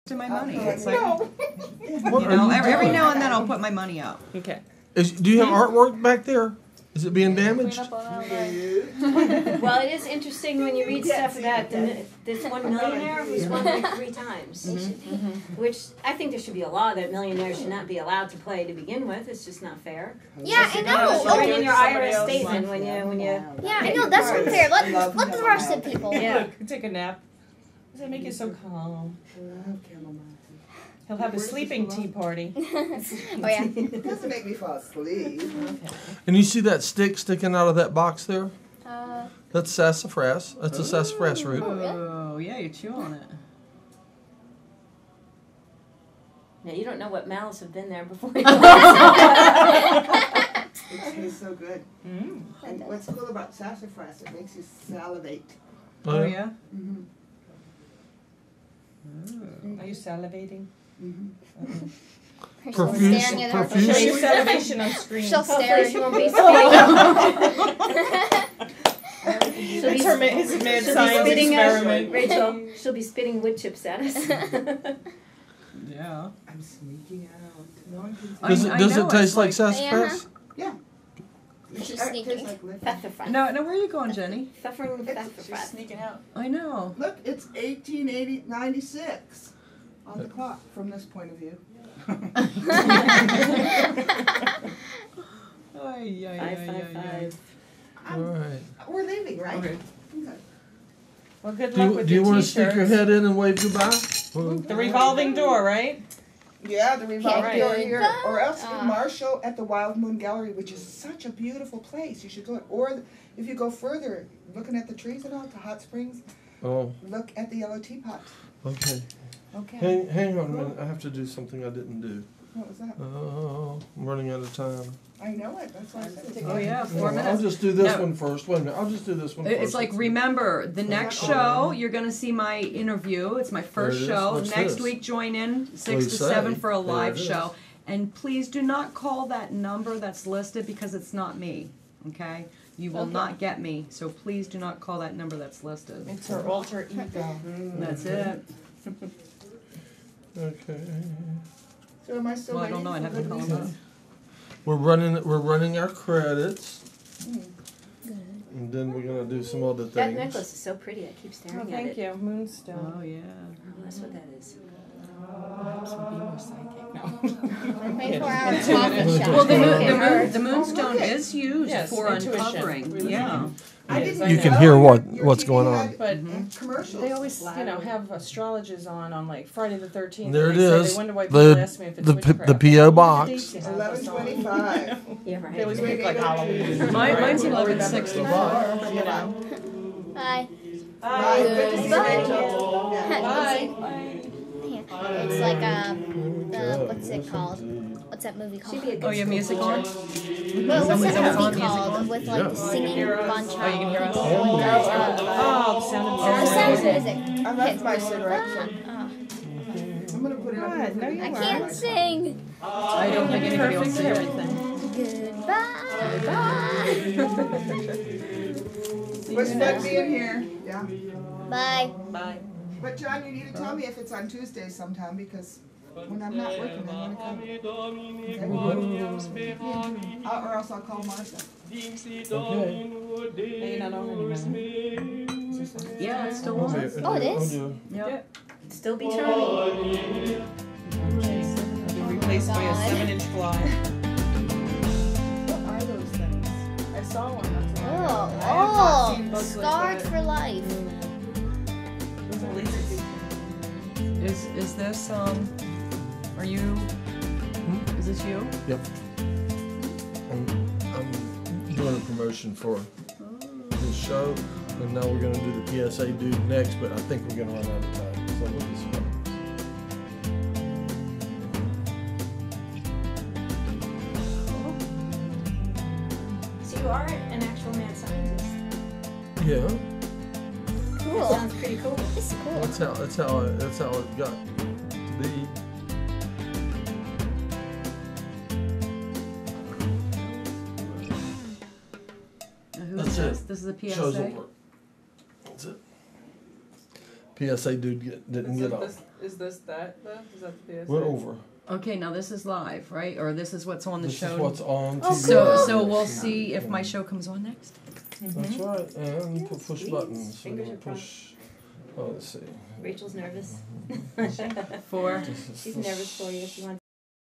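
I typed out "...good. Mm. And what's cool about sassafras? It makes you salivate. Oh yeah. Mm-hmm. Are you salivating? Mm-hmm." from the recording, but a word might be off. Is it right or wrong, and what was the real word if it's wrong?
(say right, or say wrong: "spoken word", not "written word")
right.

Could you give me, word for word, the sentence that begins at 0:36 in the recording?
And you see that stick sticking out of that box there?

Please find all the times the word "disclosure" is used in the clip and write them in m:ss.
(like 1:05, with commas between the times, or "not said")
not said.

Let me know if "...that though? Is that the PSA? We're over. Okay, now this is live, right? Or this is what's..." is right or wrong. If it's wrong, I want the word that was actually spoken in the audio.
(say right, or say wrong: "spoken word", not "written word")
right.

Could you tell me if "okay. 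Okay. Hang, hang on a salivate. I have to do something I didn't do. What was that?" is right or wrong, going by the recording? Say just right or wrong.
wrong.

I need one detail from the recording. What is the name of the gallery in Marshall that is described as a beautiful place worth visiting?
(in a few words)
Wild Moon Gallery.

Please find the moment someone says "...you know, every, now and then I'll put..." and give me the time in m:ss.
0:01.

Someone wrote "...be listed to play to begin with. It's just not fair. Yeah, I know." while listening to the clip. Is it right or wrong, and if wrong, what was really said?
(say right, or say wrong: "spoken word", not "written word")
wrong: "allowed", not "listed".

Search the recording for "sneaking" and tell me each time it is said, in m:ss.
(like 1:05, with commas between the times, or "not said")
1:16, 1:25.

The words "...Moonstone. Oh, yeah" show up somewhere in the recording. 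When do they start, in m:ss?
2:42.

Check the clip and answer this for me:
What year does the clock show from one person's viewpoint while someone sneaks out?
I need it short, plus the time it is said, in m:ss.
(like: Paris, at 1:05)
1896, at 1:27.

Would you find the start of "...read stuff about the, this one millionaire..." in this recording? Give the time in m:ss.
0:10.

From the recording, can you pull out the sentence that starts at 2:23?
So please do not call that number that's listed.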